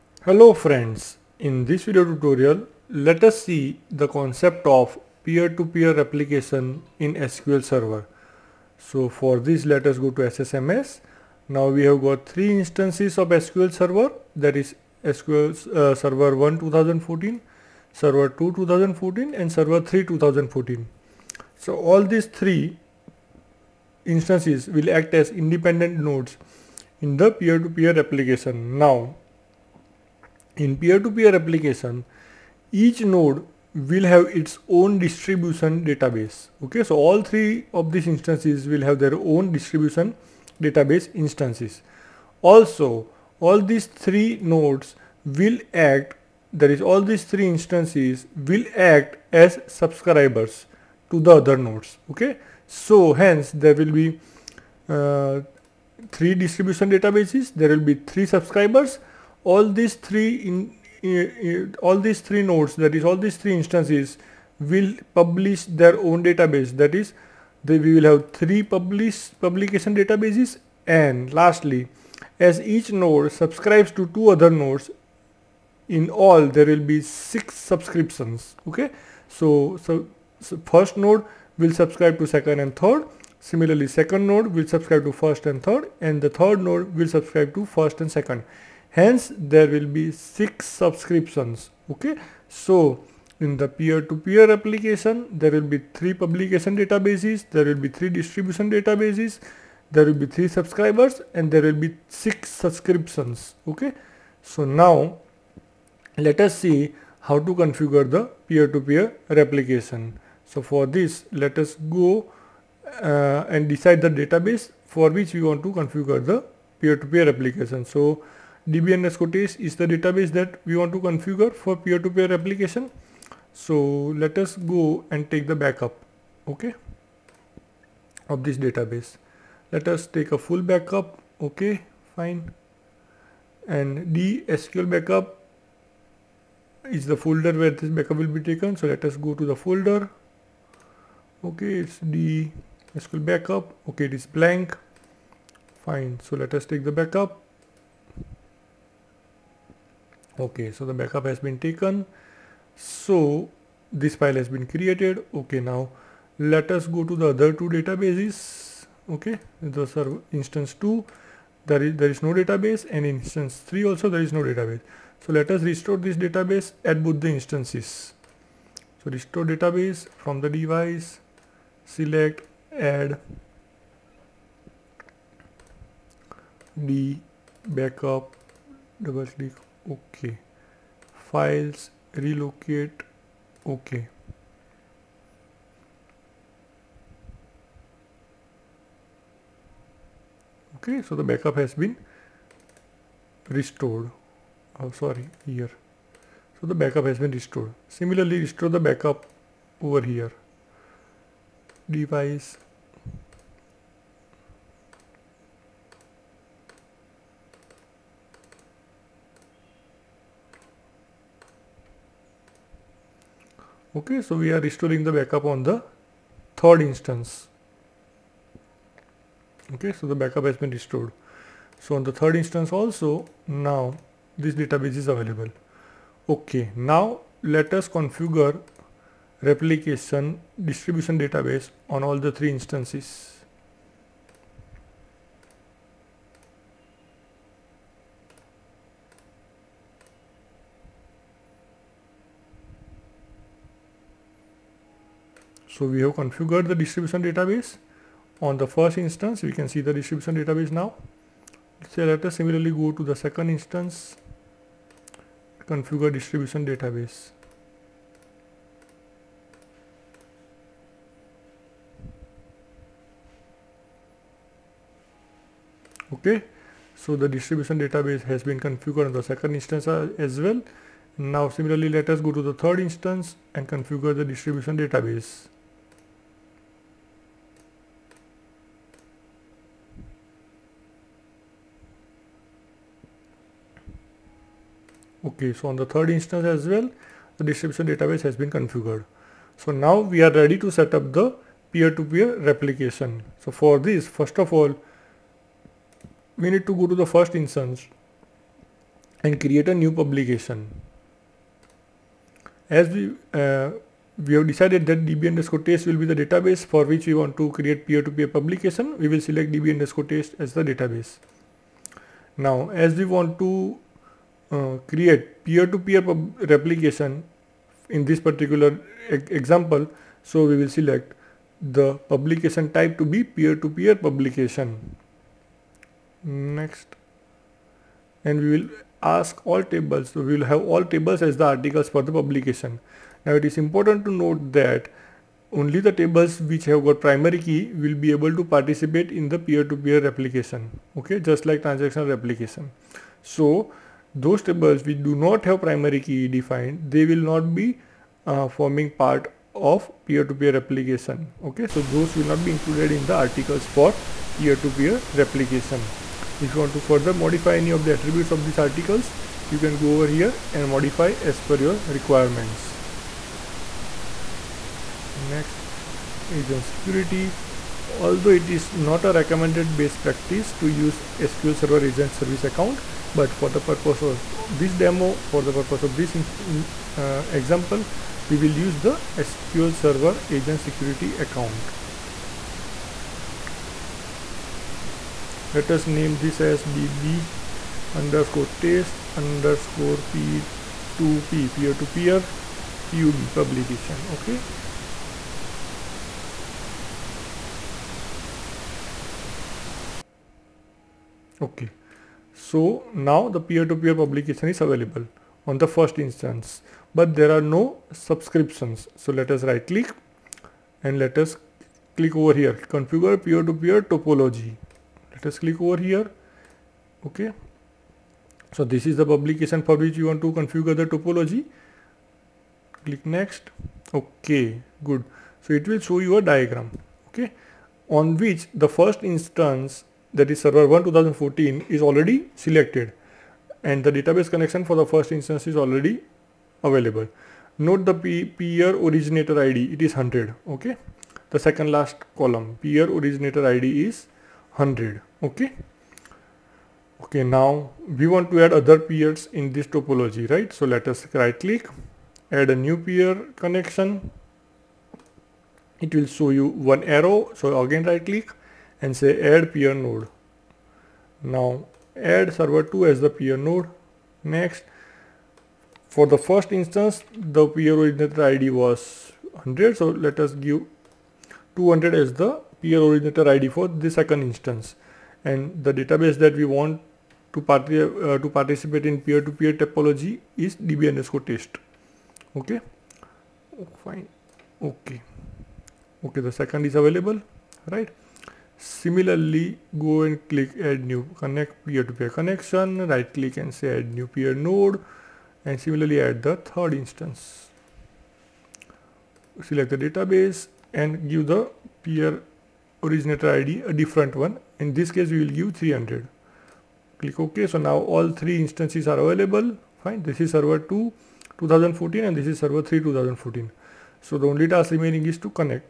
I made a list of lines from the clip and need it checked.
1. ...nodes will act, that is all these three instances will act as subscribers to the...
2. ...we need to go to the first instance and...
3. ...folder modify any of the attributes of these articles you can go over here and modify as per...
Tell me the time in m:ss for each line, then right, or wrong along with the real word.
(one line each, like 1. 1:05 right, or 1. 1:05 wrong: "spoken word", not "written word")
1. 0:44 right
2. 4:56 right
3. 5:56 wrong: "further", not "folder".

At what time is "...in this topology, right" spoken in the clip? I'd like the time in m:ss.
7:29.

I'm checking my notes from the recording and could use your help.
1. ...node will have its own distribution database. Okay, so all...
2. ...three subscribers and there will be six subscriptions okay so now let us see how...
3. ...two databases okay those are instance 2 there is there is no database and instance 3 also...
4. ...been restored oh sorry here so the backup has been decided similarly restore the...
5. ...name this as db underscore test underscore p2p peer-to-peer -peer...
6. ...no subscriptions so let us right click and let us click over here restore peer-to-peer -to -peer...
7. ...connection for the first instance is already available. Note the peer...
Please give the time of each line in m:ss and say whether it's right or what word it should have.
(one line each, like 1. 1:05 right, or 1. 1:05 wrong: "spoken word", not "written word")
1. 0:32 right
2. 1:40 right
3. 2:37 right
4. 3:11 wrong: "restored", not "decided"
5. 6:25 right
6. 6:47 wrong: "configure", not "restore"
7. 7:14 right.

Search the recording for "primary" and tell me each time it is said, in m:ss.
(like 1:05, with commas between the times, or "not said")
5:37, 5:45.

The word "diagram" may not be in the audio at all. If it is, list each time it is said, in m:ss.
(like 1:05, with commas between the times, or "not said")
7:06.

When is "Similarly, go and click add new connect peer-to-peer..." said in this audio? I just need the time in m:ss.
8:08.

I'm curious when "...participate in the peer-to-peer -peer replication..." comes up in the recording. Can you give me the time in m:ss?
5:38.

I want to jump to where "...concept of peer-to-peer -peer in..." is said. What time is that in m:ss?
0:04.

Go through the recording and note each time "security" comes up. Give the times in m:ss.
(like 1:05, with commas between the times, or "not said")
6:06, 6:20.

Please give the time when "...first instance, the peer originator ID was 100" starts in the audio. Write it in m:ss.
7:46.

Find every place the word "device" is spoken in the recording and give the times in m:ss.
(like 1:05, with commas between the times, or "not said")
2:50, 3:21.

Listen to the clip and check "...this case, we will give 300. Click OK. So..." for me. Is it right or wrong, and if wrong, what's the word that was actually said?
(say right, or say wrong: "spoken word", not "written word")
right.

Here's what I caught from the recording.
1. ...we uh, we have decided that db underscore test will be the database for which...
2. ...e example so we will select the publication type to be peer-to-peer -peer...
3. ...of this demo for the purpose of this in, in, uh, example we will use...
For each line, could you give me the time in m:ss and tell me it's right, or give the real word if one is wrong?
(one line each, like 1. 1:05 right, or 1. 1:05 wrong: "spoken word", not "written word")
1. 5:02 right
2. 5:19 right
3. 6:14 right.